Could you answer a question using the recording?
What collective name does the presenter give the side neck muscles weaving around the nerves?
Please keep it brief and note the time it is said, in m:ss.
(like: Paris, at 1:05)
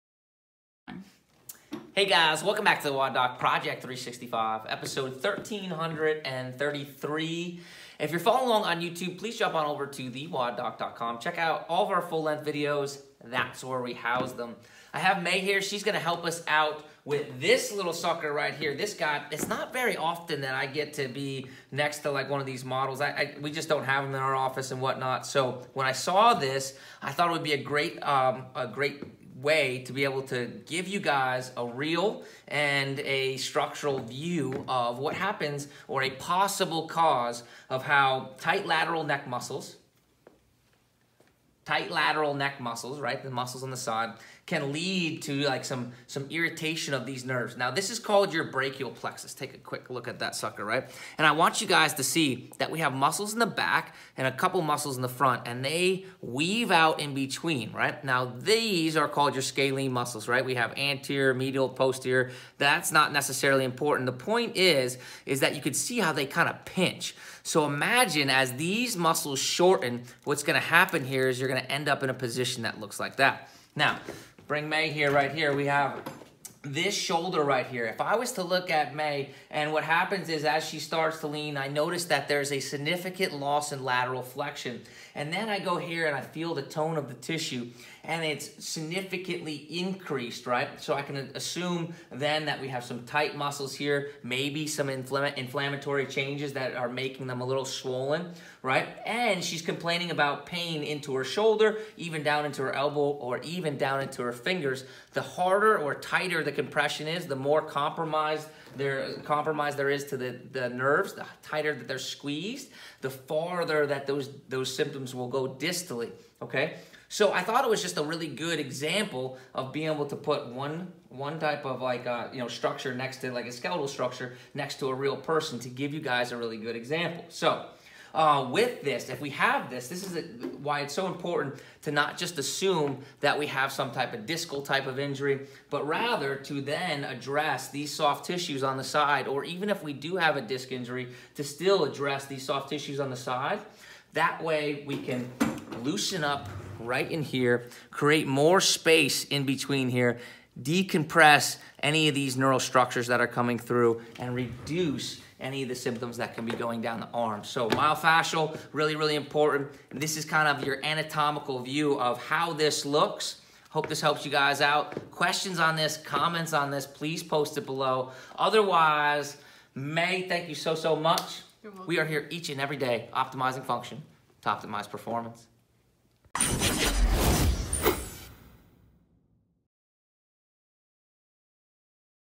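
scalene muscles, at 0:59.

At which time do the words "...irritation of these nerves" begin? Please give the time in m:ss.
0:46.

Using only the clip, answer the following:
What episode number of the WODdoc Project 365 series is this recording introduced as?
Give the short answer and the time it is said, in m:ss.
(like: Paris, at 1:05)
1333, at 0:04.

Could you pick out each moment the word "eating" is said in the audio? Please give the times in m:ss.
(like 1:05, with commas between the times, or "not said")
not said.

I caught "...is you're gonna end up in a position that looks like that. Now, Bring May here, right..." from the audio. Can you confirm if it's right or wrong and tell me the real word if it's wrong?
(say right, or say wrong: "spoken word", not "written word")
right.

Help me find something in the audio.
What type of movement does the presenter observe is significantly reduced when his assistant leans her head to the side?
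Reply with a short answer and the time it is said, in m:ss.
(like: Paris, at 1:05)
lateral flexion, at 1:23.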